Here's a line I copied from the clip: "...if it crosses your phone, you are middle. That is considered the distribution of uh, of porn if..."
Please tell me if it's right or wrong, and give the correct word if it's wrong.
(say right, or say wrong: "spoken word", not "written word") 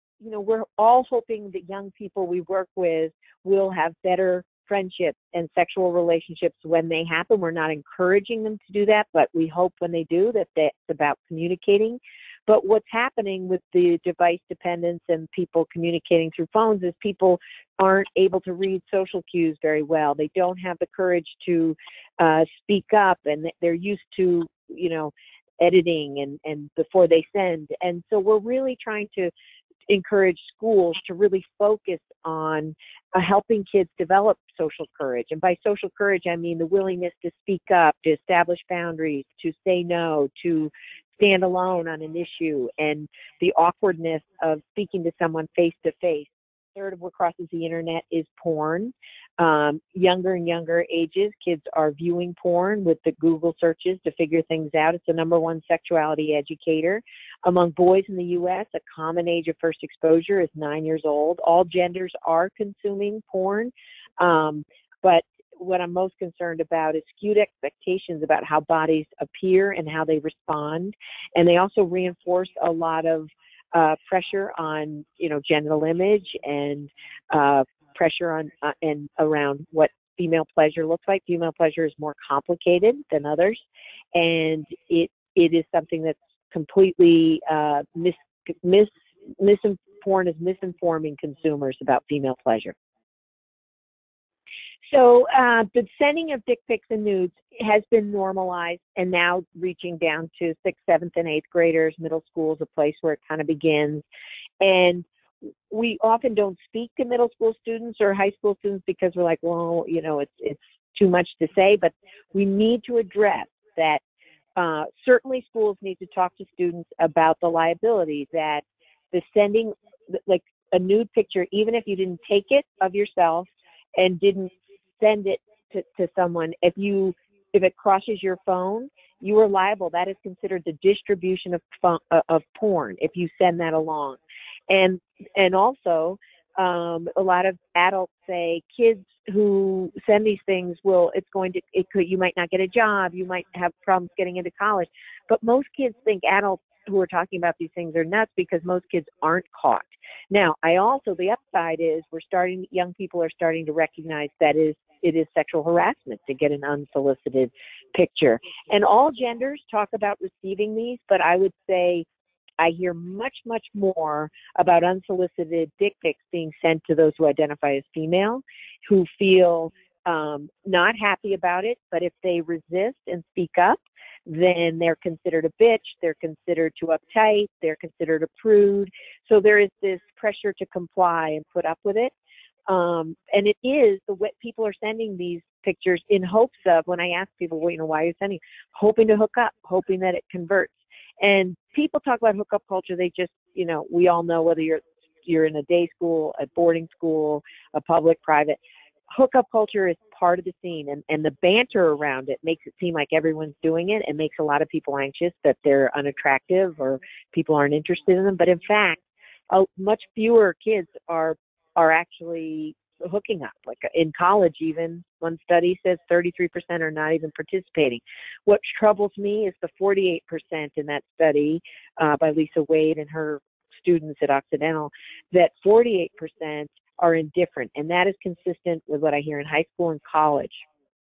wrong: "liable", not "middle".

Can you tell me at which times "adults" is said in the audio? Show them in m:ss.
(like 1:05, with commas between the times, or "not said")
2:17, 2:26.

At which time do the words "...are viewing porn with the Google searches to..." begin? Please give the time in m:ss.
0:51.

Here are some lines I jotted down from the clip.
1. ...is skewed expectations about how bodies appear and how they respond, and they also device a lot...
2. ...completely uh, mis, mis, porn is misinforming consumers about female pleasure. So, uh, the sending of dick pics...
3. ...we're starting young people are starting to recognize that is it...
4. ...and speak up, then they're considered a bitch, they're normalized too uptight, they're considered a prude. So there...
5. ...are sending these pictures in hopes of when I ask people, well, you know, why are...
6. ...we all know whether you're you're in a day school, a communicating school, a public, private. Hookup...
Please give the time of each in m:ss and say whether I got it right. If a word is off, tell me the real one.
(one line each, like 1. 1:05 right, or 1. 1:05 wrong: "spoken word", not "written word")
1. 1:06 wrong: "reinforce", not "device"
2. 1:26 right
3. 2:32 right
4. 2:53 wrong: "considered", not "normalized"
5. 3:04 right
6. 3:13 wrong: "boarding", not "communicating".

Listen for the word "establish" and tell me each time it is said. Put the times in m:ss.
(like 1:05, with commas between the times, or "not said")
0:38.